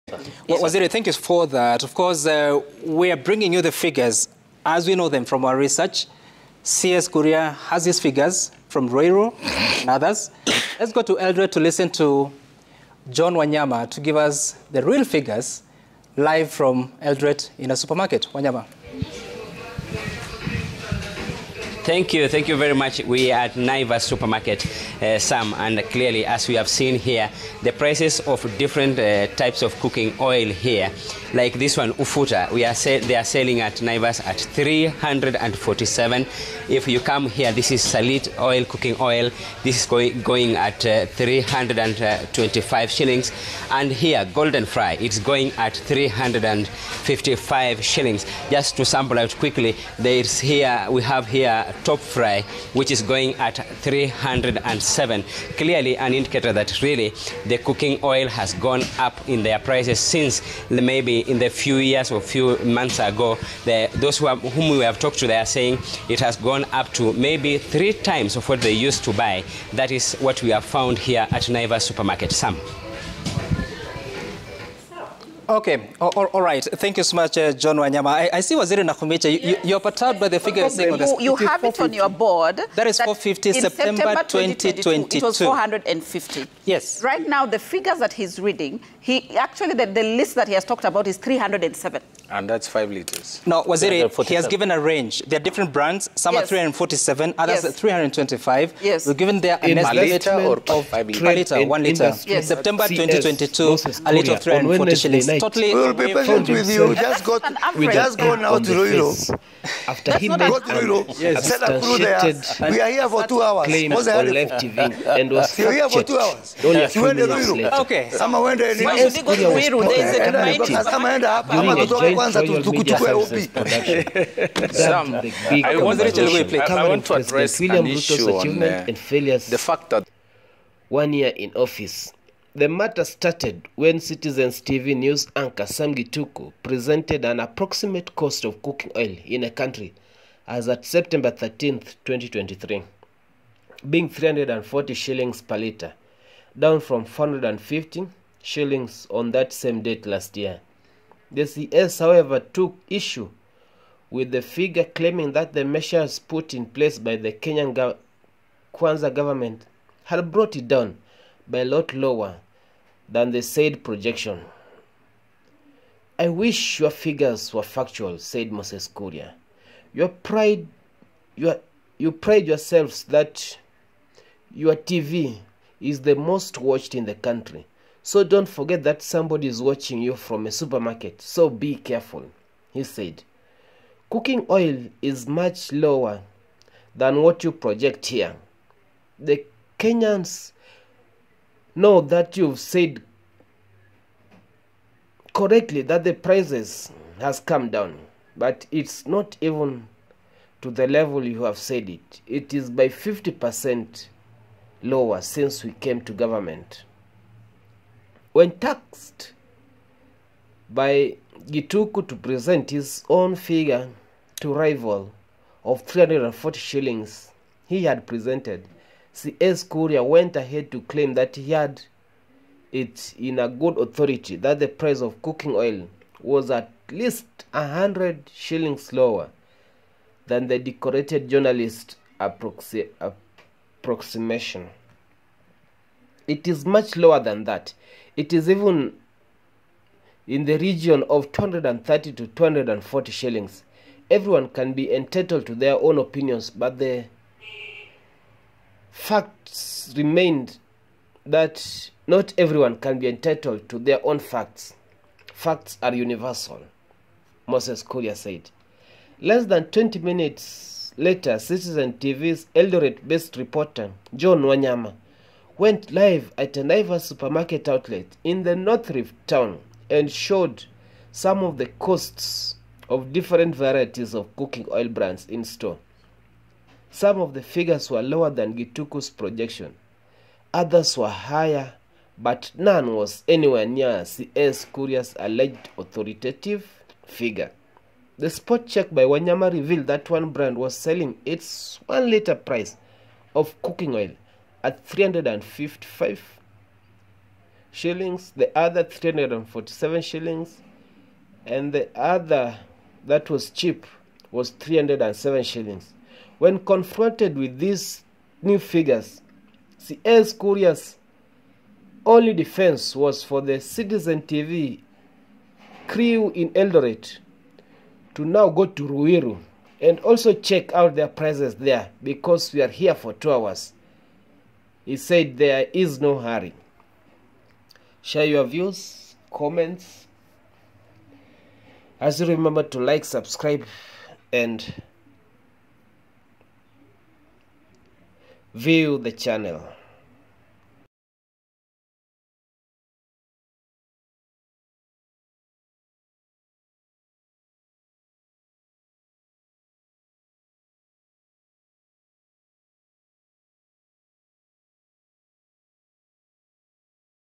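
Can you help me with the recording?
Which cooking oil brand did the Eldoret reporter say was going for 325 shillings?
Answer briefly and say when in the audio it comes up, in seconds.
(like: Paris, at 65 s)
Salit, at 37 s.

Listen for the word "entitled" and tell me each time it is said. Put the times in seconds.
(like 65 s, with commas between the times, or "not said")
244 s, 253 s.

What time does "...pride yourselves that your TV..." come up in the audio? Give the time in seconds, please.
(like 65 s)
172 s.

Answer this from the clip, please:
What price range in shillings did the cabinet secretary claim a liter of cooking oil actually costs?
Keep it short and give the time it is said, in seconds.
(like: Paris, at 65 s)
230 to 240 shillings, at 241 s.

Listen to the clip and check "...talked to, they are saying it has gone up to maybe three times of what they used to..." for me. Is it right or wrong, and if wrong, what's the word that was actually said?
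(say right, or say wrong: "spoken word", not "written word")
right.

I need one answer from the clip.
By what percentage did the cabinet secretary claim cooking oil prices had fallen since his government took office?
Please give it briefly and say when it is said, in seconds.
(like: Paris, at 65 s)
50%, at 202 s.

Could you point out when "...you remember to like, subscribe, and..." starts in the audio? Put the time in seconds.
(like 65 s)
332 s.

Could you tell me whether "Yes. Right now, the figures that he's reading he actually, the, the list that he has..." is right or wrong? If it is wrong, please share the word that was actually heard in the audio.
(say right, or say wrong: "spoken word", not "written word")
right.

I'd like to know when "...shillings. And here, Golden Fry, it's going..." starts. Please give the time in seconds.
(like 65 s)
42 s.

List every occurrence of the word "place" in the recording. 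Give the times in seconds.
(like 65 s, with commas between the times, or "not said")
156 s.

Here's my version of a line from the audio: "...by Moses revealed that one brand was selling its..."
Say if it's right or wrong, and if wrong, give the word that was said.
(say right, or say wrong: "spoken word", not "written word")
wrong: "Wanyama", not "Moses".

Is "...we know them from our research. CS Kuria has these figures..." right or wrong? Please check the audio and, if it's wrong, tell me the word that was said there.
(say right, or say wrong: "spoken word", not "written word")
right.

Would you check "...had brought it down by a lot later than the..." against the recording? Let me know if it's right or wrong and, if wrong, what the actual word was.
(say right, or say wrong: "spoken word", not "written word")
wrong: "lower", not "later".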